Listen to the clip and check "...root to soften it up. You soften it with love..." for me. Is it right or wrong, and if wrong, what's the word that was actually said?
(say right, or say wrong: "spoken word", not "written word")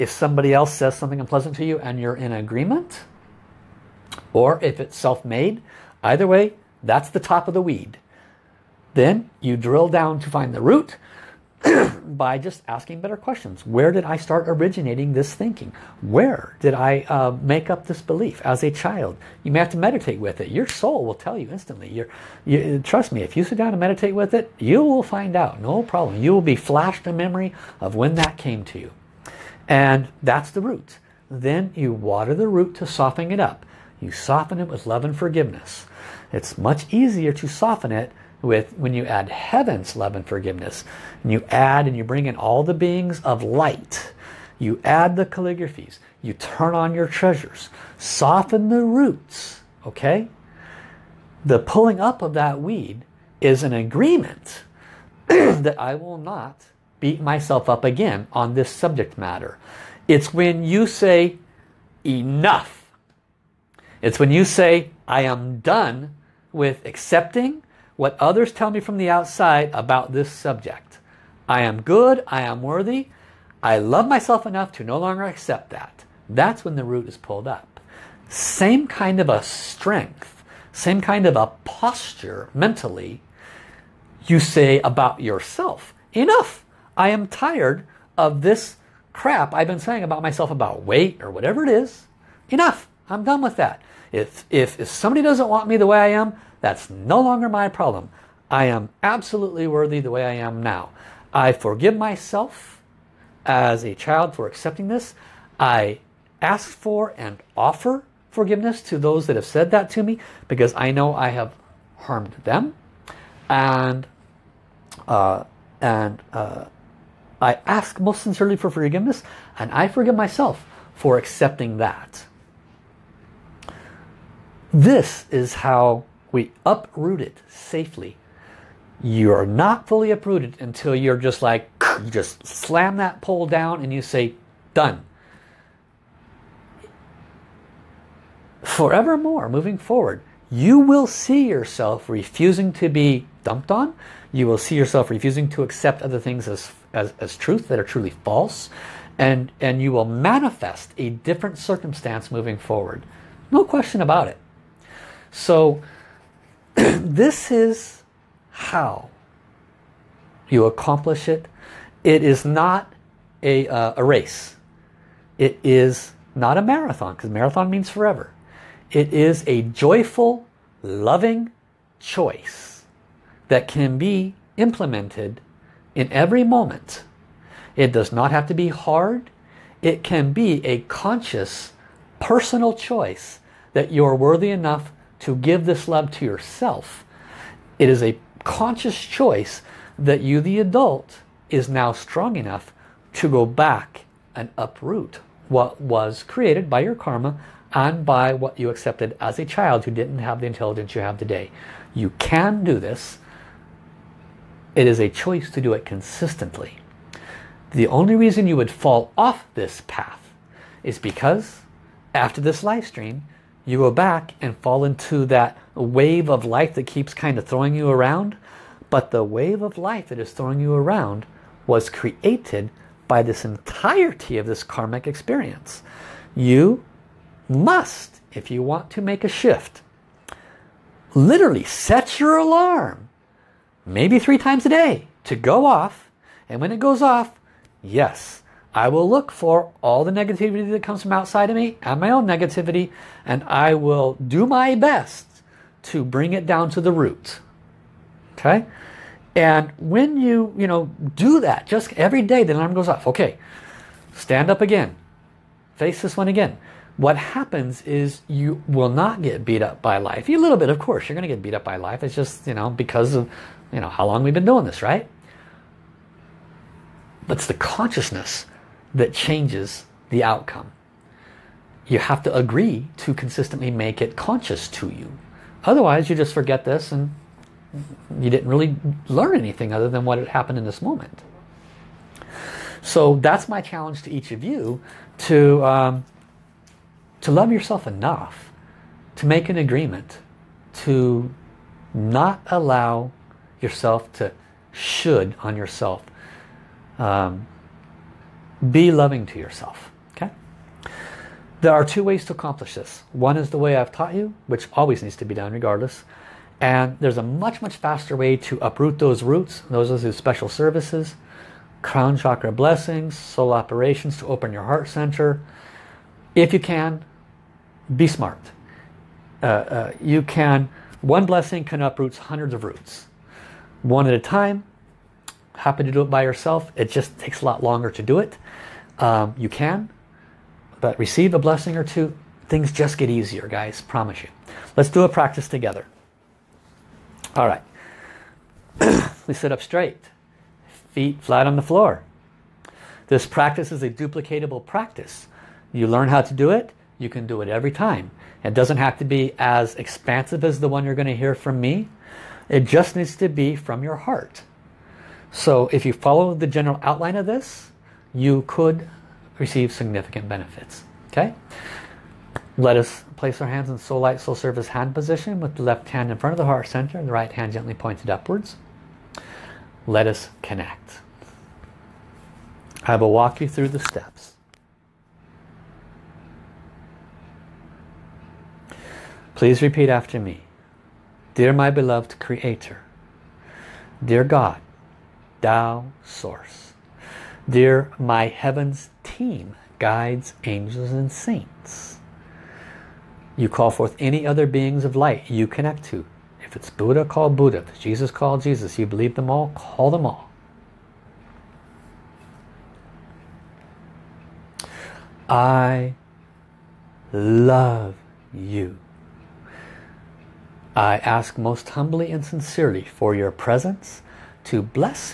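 right.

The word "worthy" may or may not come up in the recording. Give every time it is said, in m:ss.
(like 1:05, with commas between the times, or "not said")
1:12, 1:39, 3:04.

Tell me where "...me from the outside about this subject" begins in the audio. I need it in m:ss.
1:08.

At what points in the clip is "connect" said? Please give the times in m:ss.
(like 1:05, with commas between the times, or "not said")
6:10, 6:35.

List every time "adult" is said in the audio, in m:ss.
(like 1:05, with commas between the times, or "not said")
3:10.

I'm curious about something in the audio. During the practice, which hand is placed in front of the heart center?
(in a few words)
Left hand.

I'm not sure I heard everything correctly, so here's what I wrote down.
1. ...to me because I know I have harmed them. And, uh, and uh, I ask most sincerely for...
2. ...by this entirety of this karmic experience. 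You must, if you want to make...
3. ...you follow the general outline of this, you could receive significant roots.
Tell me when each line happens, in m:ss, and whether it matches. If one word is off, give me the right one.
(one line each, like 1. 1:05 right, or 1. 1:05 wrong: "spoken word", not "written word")
1. 1:49 right
2. 3:43 right
3. 5:55 wrong: "benefits", not "roots".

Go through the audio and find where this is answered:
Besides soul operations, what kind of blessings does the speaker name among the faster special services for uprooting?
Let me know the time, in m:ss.
5:11.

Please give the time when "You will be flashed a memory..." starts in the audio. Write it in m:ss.
0:26.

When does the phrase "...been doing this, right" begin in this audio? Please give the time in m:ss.
4:24.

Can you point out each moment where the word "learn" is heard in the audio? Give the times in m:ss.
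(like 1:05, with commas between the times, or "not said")
4:39, 5:45.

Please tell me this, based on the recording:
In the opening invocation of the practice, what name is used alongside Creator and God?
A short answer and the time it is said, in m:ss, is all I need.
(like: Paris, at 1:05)
Tao Source, at 6:25.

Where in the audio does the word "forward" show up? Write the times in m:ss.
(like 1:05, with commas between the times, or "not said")
2:19, 2:32.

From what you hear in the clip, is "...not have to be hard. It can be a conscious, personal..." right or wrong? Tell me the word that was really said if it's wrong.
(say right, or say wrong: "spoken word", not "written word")
right.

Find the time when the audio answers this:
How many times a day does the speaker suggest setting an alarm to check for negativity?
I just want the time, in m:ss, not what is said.
3:54.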